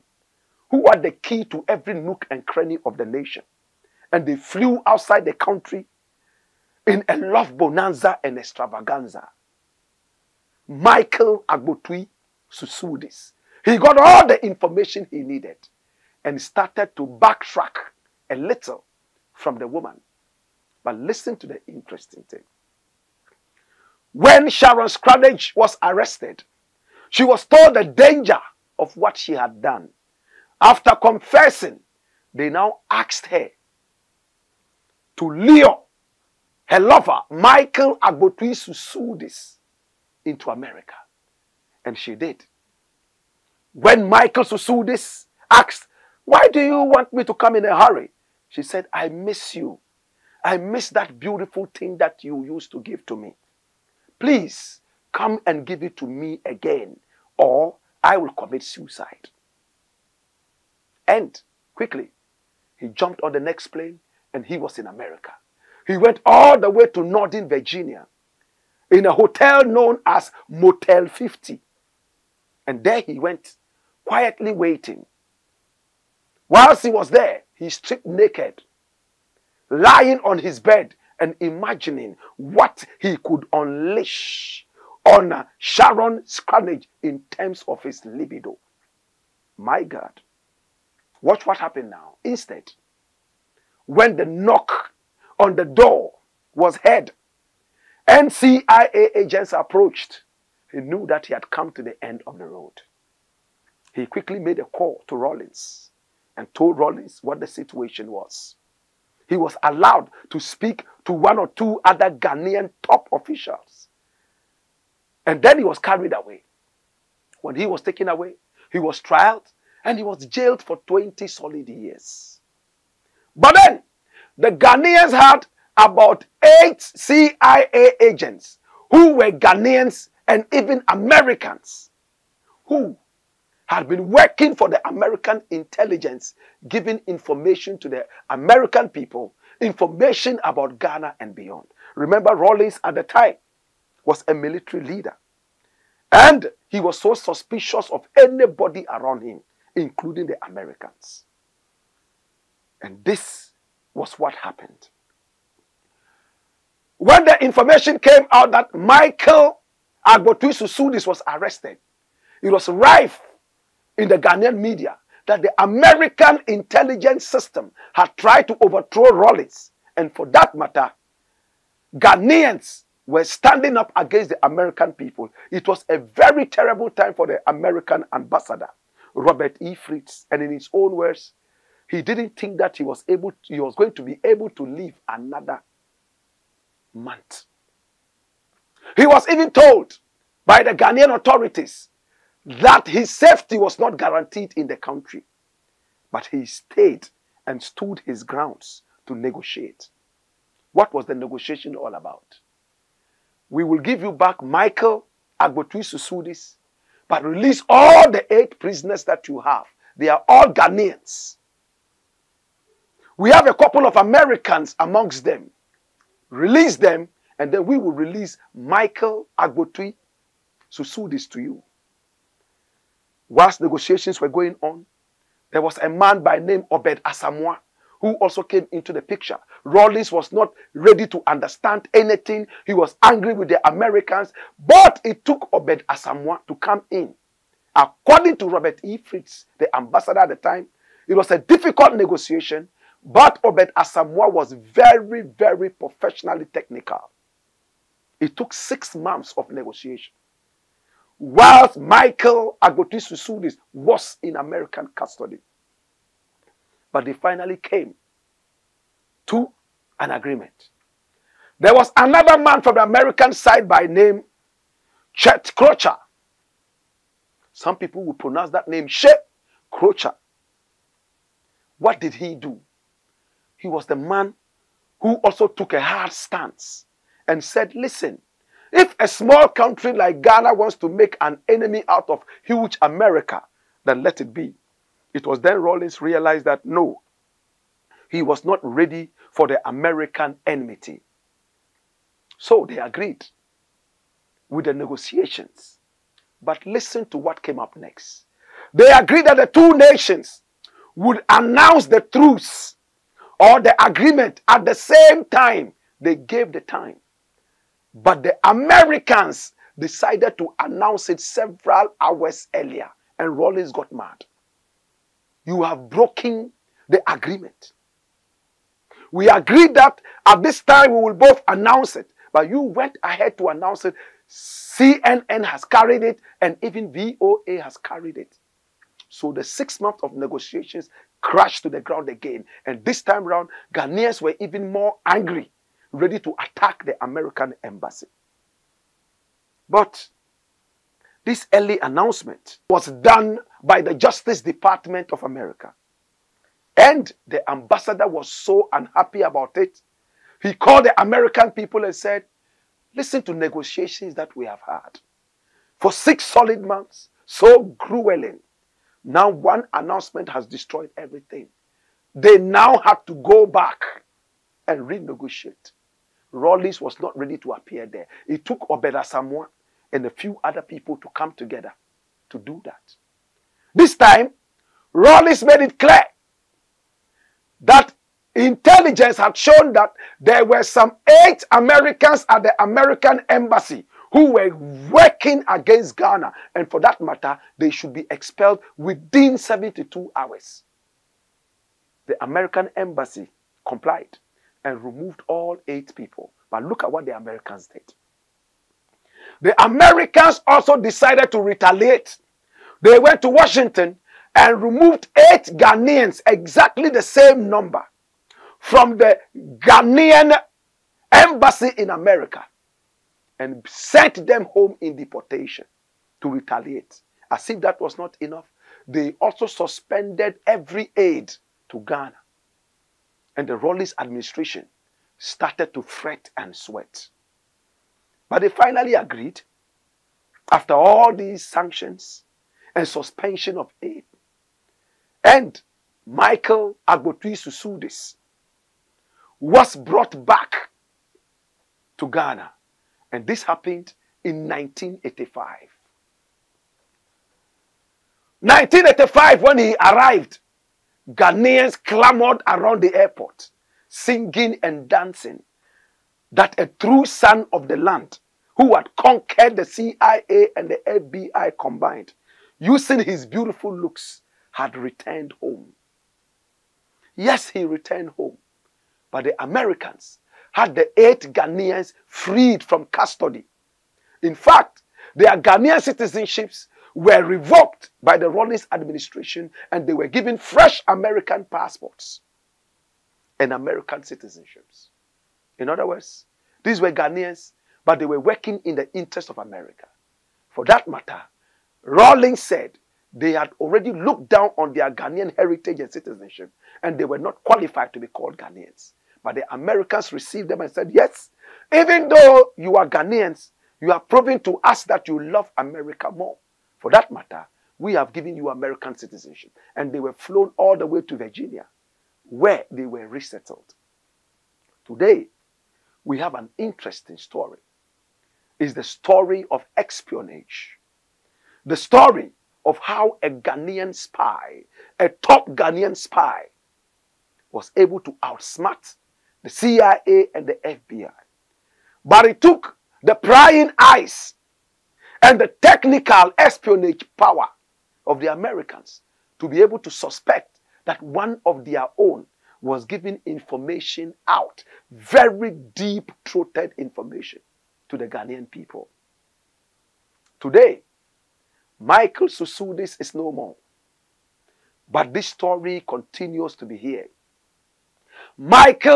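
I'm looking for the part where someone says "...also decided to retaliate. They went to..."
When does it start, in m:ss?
6:40.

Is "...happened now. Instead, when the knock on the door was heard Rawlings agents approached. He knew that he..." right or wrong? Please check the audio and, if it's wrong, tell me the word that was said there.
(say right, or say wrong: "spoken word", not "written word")
wrong: "NCIA", not "Rawlings".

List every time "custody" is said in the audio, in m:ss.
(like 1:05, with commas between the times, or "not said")
4:14, 7:52.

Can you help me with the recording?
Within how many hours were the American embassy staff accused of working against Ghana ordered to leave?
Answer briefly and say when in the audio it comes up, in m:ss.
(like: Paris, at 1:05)
72, at 6:29.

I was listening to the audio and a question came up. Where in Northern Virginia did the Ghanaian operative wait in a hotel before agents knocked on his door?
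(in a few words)
Motel 50.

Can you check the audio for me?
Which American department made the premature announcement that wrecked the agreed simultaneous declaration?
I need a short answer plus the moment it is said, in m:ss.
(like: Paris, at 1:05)
Justice Department, at 5:43.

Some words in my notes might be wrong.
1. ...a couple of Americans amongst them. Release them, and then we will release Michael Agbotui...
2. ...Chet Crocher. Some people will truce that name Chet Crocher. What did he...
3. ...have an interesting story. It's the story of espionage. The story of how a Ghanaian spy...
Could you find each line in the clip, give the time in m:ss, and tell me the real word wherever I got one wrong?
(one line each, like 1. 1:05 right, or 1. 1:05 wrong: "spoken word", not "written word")
1. 3:33 right
2. 4:25 wrong: "pronounce", not "truce"
3. 8:36 right.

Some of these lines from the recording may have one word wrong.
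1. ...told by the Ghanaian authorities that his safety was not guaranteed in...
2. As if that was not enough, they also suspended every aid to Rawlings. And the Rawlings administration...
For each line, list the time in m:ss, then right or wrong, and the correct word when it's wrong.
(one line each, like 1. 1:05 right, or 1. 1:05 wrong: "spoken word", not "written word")
1. 3:09 right
2. 6:57 wrong: "Ghana", not "Rawlings".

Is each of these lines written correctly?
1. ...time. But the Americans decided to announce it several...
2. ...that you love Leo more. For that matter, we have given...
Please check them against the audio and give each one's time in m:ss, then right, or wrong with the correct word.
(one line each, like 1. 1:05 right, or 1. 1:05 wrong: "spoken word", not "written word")
1. 5:06 right
2. 8:24 wrong: "America", not "Leo".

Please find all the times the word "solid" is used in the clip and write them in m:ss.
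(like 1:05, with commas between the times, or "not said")
2:01, 5:56.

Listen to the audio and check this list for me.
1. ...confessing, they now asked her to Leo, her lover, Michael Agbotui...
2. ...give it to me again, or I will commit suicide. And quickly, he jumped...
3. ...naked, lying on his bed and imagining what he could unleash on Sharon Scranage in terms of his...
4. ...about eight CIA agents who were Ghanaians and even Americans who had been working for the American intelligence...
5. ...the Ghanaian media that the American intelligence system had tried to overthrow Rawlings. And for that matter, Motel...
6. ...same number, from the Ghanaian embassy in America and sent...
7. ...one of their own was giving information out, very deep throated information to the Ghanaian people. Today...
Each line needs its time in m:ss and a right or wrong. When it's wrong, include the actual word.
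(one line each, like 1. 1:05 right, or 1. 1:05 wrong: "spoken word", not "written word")
1. 0:30 right
2. 0:55 right
3. 1:18 right
4. 2:05 right
5. 2:44 wrong: "Ghanaians", not "Motel"
6. 6:47 right
7. 9:01 right.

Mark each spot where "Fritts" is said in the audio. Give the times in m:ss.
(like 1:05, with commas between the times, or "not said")
2:59, 3:58.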